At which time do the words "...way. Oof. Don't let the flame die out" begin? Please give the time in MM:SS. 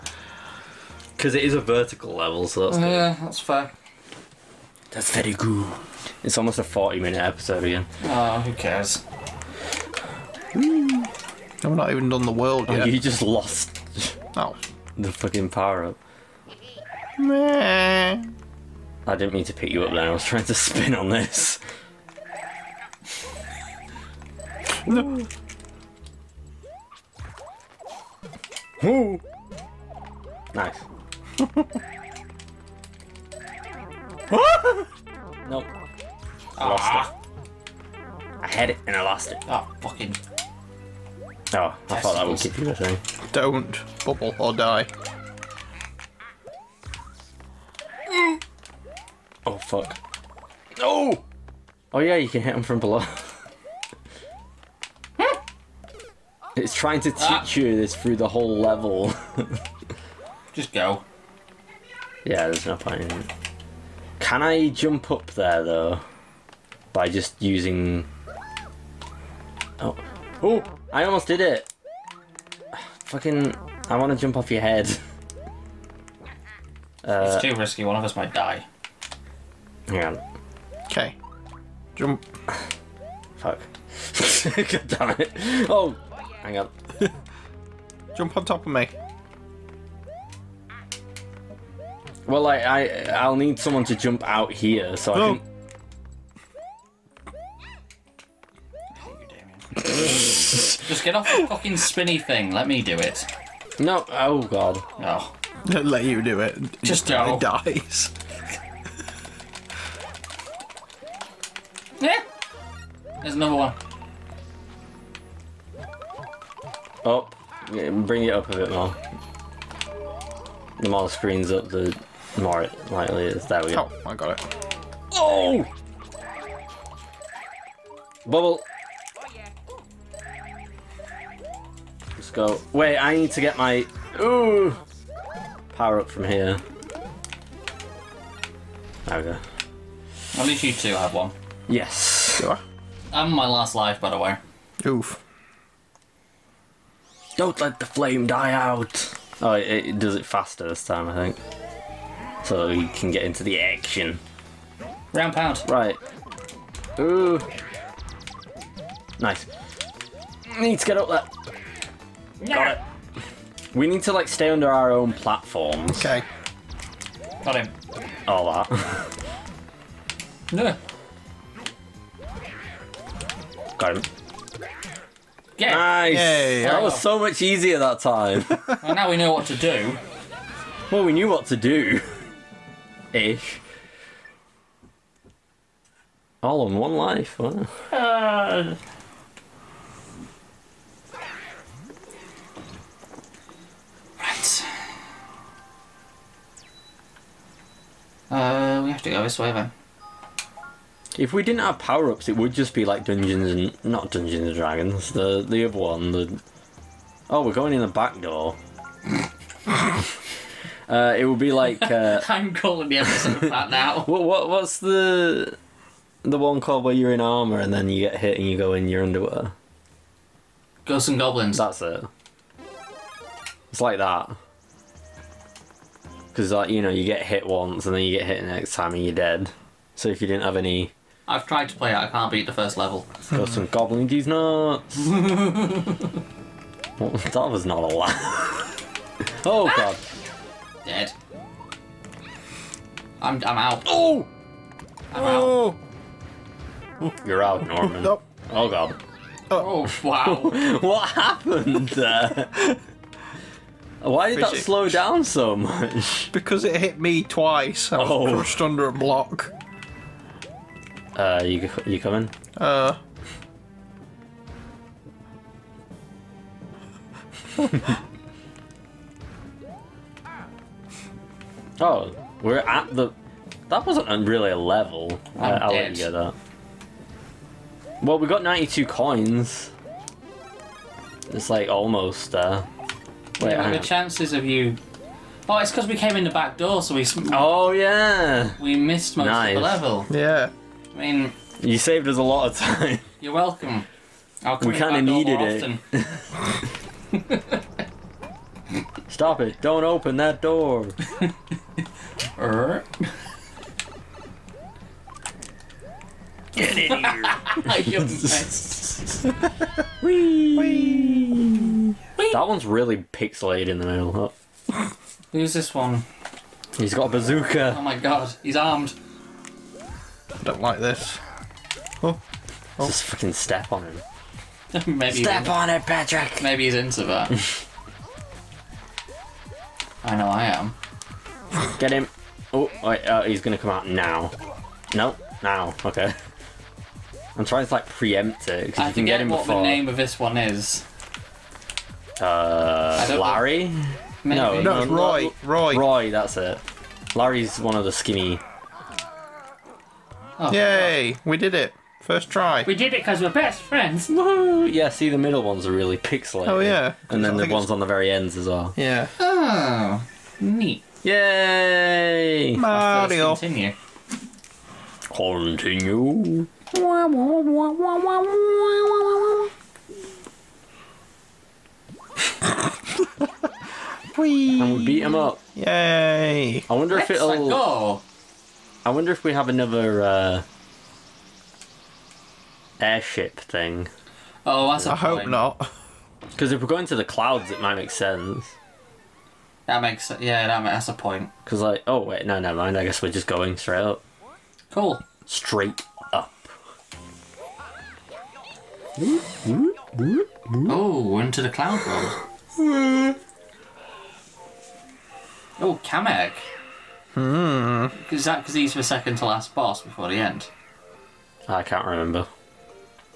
02:24.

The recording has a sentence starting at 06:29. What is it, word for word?
That makes yeah, that that's a point.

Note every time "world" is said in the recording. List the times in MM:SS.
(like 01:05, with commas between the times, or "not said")
00:12, 06:41.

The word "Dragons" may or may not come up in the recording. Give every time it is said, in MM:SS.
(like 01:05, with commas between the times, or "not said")
03:24.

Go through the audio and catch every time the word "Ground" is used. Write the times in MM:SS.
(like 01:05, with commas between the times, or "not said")
02:35.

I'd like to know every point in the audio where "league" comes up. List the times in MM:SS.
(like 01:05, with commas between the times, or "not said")
not said.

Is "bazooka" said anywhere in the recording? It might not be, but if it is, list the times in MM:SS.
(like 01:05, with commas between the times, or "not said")
05:17.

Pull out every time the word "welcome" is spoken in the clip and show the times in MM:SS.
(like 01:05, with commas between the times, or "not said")
04:53.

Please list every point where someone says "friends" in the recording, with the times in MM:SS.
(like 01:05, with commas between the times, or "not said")
05:53.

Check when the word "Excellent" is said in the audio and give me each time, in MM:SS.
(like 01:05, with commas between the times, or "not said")
06:16.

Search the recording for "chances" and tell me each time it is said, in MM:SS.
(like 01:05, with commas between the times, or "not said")
04:43.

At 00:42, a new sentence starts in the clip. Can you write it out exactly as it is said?
thought that would keep you the thing.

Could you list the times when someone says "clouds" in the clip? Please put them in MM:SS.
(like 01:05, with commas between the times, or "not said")
06:27, 06:41.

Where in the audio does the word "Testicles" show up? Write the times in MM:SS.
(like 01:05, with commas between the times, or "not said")
00:41.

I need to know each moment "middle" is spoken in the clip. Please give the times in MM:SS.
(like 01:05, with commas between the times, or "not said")
05:13, 05:55.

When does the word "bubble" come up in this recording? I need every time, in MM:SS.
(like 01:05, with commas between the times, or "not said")
00:44, 02:08.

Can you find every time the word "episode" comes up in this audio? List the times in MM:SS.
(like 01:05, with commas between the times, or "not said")
00:07, 03:32.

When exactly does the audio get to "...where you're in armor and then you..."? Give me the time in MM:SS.
03:36.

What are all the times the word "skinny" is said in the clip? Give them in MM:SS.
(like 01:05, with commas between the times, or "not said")
05:47.